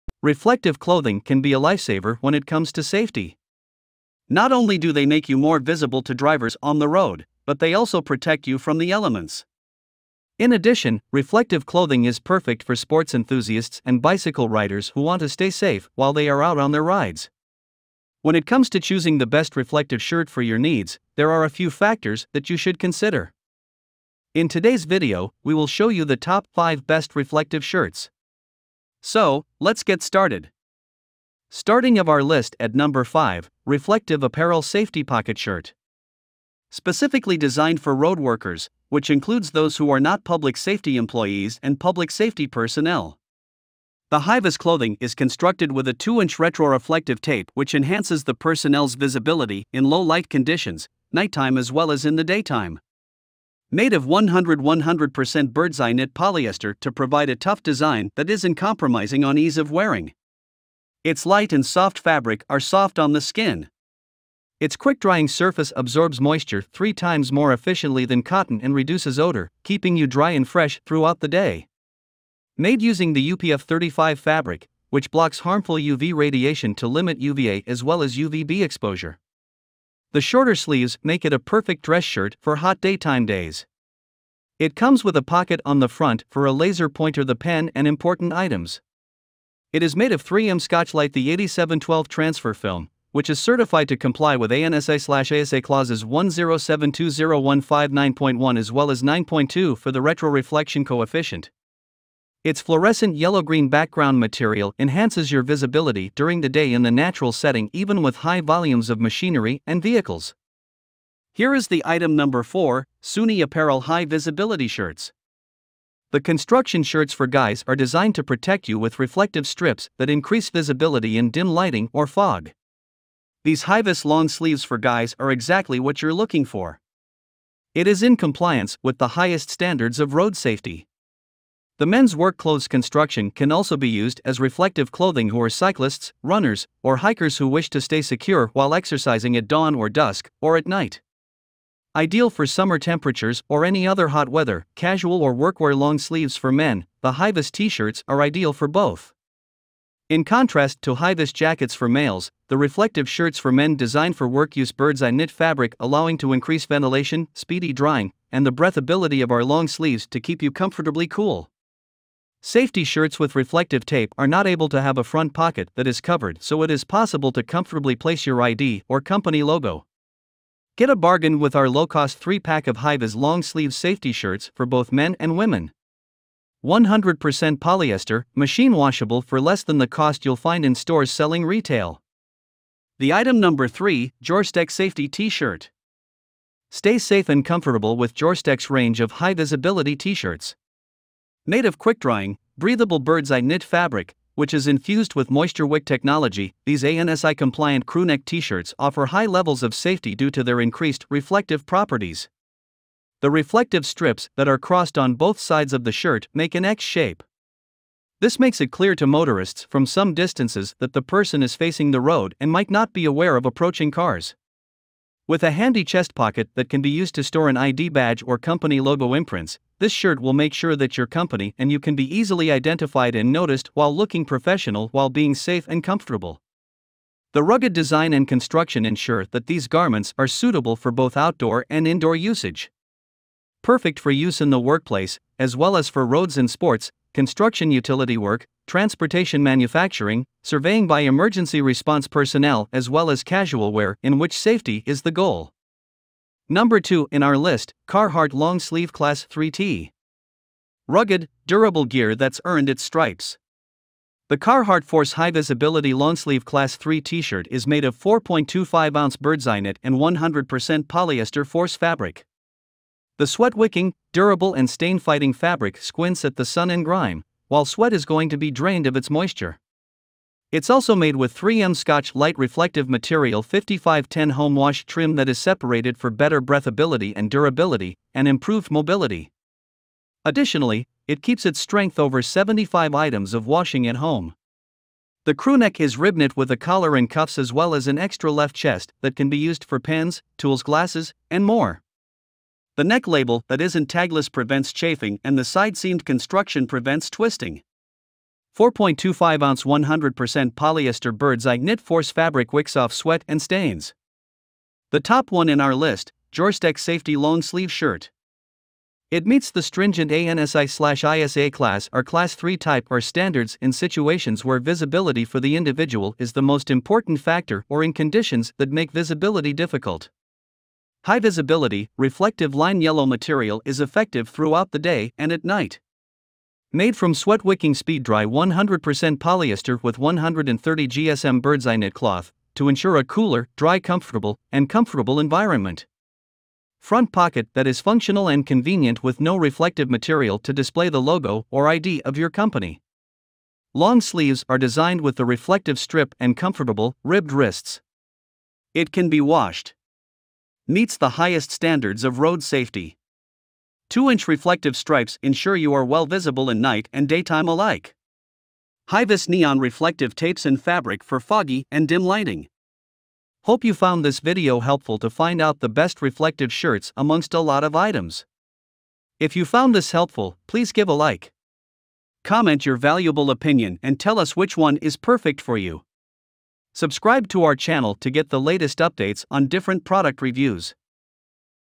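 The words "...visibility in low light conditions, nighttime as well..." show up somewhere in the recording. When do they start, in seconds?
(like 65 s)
48 s.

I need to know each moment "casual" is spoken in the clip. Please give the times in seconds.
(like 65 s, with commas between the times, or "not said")
144 s, 243 s.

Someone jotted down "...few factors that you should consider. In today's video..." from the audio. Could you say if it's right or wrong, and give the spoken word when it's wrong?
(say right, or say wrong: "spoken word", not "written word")
right.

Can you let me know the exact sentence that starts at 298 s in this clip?
4.25 ounce 100% polyester bird's eye knit force fabric wicks off sweat and stains.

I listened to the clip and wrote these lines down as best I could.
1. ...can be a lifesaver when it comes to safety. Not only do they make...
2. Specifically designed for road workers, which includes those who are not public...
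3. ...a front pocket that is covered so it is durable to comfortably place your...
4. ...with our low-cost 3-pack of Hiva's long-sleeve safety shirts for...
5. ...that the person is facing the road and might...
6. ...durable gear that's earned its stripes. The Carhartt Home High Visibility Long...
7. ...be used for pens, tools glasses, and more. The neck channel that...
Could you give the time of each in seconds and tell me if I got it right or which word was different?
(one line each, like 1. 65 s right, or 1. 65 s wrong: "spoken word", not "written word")
1. 1 s right
2. 36 s right
3. 164 s wrong: "possible", not "durable"
4. 171 s right
5. 210 s right
6. 251 s wrong: "Force", not "Home"
7. 289 s wrong: "label", not "channel".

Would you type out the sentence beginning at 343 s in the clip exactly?
Long sleeves are designed with the reflective strip and comfortable, ribbed wrists.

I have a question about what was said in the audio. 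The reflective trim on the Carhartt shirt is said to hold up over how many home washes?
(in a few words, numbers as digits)
75.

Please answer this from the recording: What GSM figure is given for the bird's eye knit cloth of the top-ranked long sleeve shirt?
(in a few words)
130 GSM.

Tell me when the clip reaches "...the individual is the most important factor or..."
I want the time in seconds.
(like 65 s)
315 s.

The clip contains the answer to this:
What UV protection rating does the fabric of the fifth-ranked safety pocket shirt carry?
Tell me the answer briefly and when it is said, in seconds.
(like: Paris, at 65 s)
UPF 35, at 73 s.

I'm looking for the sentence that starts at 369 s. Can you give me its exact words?
If you found this helpful, please give a like.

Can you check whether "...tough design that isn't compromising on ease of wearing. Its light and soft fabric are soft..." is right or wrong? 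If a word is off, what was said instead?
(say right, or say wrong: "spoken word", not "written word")
right.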